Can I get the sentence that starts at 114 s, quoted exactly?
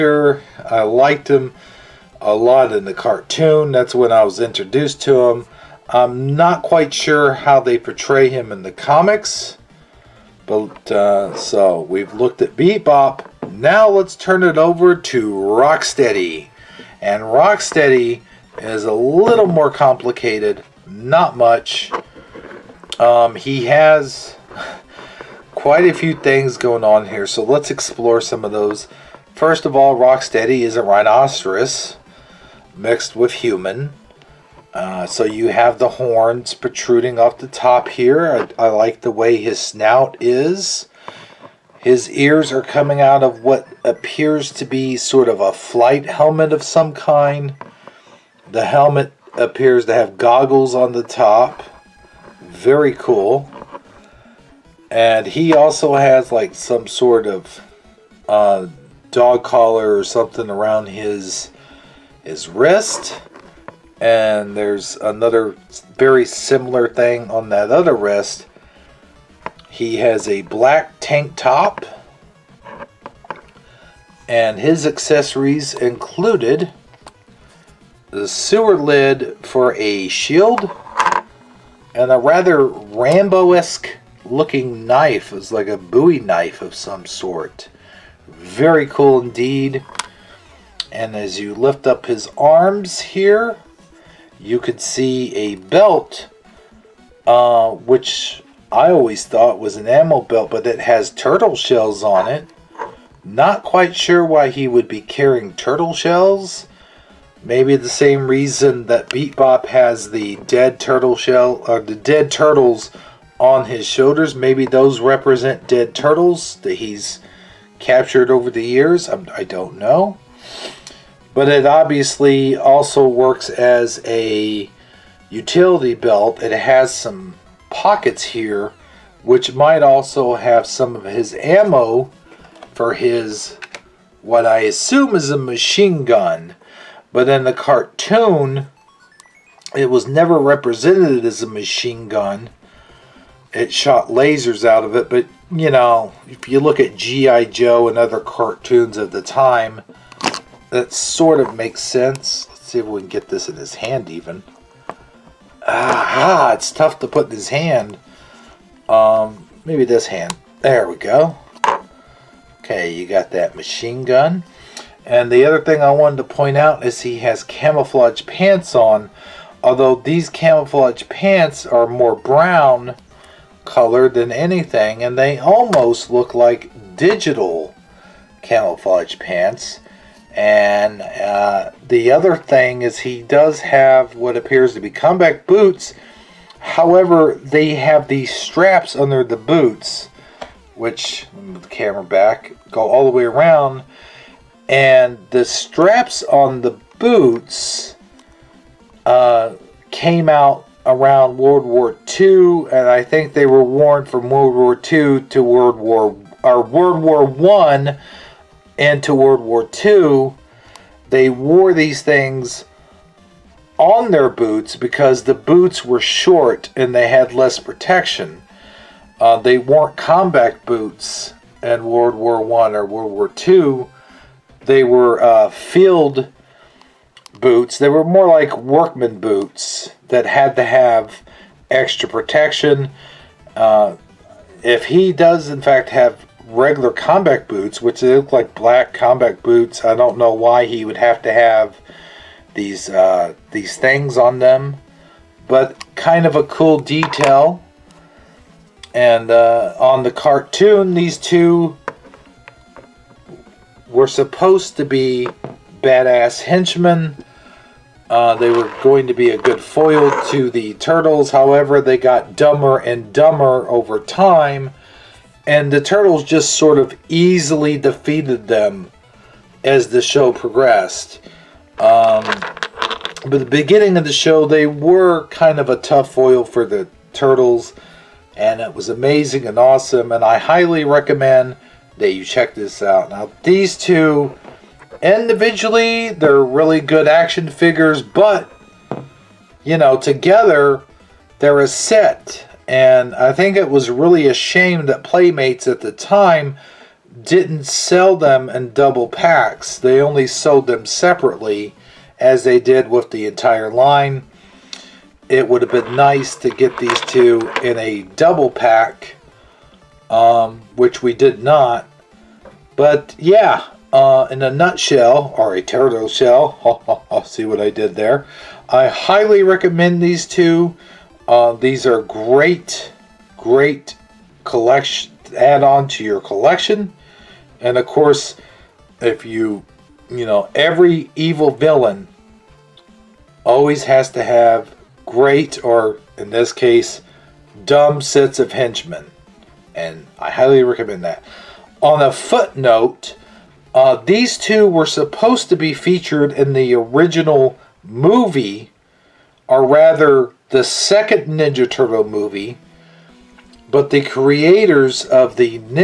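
Maybe those represent dead turtles that he's captured over the years.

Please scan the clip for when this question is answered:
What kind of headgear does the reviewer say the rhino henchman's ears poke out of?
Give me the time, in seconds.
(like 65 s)
45 s.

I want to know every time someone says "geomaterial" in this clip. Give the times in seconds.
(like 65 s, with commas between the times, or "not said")
not said.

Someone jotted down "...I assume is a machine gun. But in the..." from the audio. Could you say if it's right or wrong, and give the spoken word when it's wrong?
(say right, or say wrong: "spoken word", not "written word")
right.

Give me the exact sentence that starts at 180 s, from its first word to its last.
And uh, the other thing is he does have what appears to be combat boots.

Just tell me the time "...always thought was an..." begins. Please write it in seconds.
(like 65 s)
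98 s.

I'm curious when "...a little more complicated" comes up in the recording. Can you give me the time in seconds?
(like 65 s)
18 s.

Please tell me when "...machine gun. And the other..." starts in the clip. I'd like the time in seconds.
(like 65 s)
163 s.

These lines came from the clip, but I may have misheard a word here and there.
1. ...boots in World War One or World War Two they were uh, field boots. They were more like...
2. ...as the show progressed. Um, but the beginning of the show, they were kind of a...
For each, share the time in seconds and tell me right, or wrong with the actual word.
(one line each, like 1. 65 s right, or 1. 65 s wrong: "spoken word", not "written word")
1. 220 s right
2. 269 s right.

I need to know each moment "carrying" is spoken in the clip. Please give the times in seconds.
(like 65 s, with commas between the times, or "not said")
105 s.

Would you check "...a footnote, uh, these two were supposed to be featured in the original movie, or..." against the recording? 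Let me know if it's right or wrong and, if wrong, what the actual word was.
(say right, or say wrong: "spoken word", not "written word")
right.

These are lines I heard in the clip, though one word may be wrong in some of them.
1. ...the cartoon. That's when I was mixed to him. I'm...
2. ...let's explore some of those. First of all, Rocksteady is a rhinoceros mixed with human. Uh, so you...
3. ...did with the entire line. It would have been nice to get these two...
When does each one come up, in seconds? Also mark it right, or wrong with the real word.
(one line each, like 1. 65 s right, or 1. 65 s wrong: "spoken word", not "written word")
1. 2 s wrong: "introduced", not "mixed"
2. 27 s right
3. 302 s right.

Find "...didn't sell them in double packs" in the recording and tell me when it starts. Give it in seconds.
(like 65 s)
297 s.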